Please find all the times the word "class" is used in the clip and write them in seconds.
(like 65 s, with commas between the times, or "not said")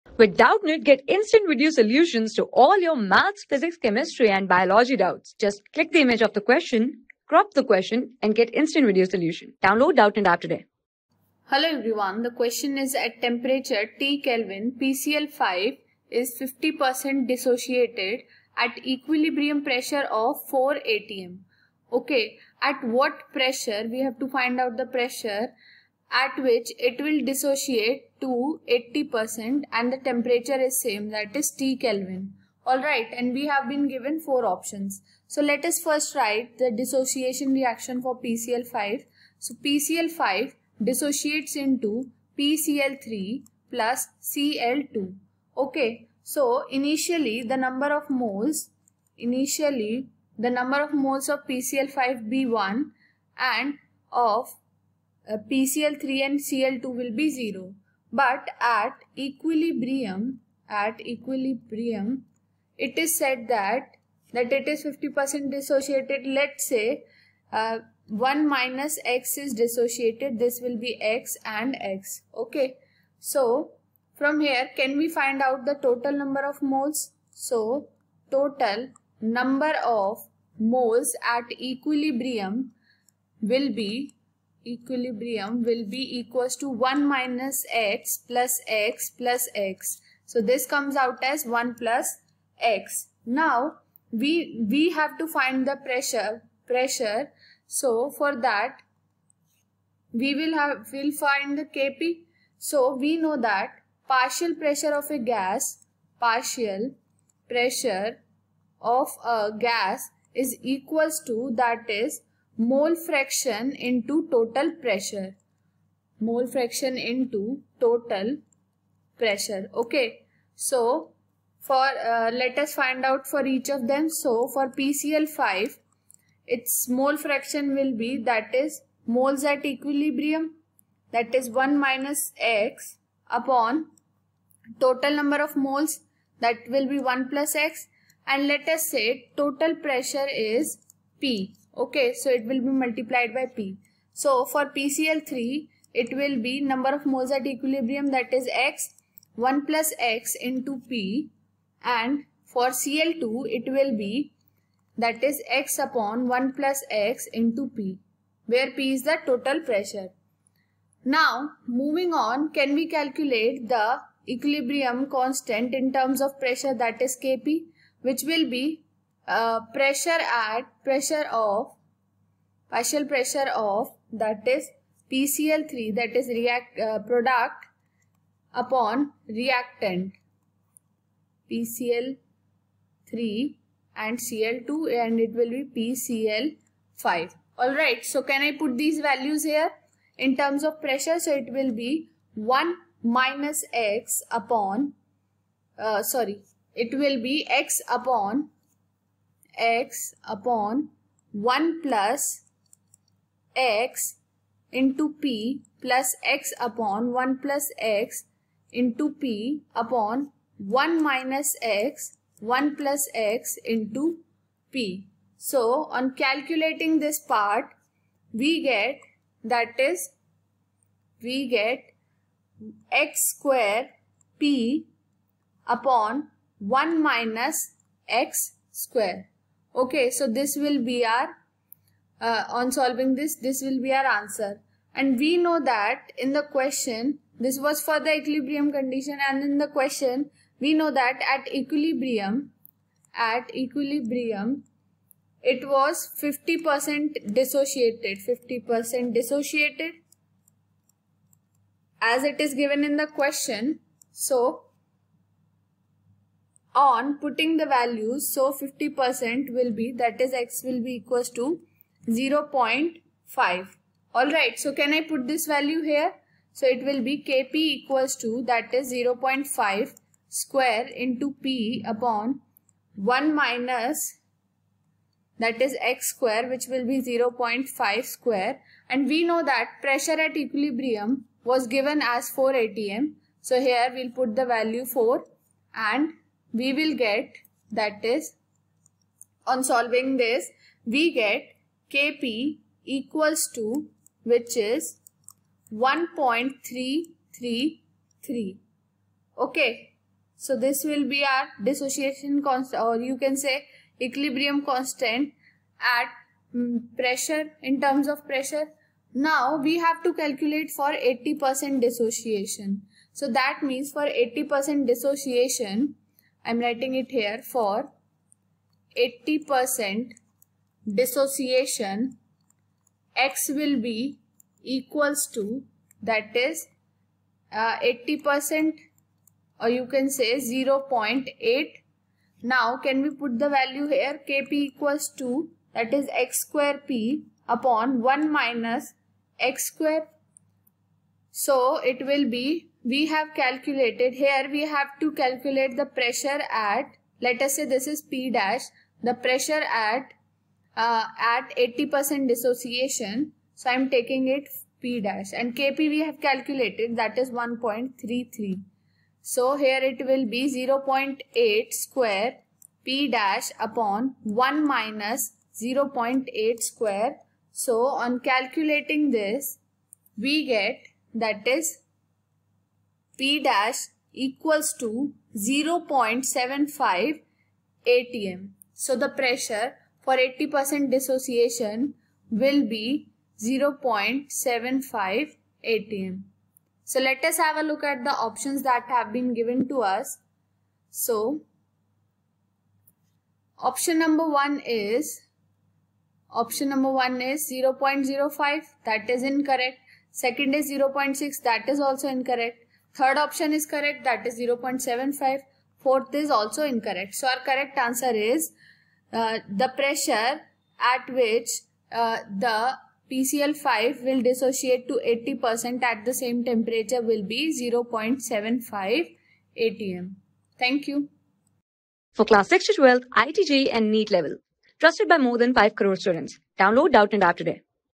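422 s.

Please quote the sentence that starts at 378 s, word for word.
So the pressure for 80% dissociation will be 0.75 atm.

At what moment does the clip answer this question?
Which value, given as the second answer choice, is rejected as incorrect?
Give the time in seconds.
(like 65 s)
400 s.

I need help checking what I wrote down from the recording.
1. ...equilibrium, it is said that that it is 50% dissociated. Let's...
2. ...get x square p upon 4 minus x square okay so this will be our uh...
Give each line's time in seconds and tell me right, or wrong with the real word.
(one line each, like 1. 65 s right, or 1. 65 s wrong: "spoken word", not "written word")
1. 61 s right
2. 221 s wrong: "1", not "4".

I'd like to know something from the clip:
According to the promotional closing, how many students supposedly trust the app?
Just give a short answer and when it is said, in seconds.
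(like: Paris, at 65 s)
more than 5 crore, at 425 s.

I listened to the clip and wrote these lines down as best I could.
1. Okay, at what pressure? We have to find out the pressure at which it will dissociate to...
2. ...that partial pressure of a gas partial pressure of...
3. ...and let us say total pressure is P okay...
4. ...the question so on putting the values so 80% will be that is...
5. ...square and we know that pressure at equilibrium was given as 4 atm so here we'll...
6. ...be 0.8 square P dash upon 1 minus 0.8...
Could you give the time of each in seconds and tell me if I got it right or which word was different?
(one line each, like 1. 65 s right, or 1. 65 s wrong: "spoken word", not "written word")
1. 21 s right
2. 103 s right
3. 138 s right
4. 252 s wrong: "50", not "80"
5. 278 s right
6. 360 s right.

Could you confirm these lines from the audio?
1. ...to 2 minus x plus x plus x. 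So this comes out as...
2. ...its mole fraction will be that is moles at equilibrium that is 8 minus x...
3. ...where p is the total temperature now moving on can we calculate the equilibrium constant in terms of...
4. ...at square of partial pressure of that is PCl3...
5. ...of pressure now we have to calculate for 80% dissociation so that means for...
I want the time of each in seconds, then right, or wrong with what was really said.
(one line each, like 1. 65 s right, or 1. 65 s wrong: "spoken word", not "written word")
1. 86 s wrong: "1", not "2"
2. 126 s wrong: "1", not "8"
3. 158 s wrong: "pressure", not "temperature"
4. 170 s wrong: "pressure", not "square"
5. 308 s right.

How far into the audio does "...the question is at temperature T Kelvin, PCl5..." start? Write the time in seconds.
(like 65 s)
12 s.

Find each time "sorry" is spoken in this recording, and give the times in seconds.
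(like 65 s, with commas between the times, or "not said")
196 s.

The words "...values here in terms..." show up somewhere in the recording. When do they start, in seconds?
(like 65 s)
189 s.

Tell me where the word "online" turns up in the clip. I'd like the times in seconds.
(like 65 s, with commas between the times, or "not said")
not said.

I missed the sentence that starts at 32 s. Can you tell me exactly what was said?
Alright and we have been given 4 options.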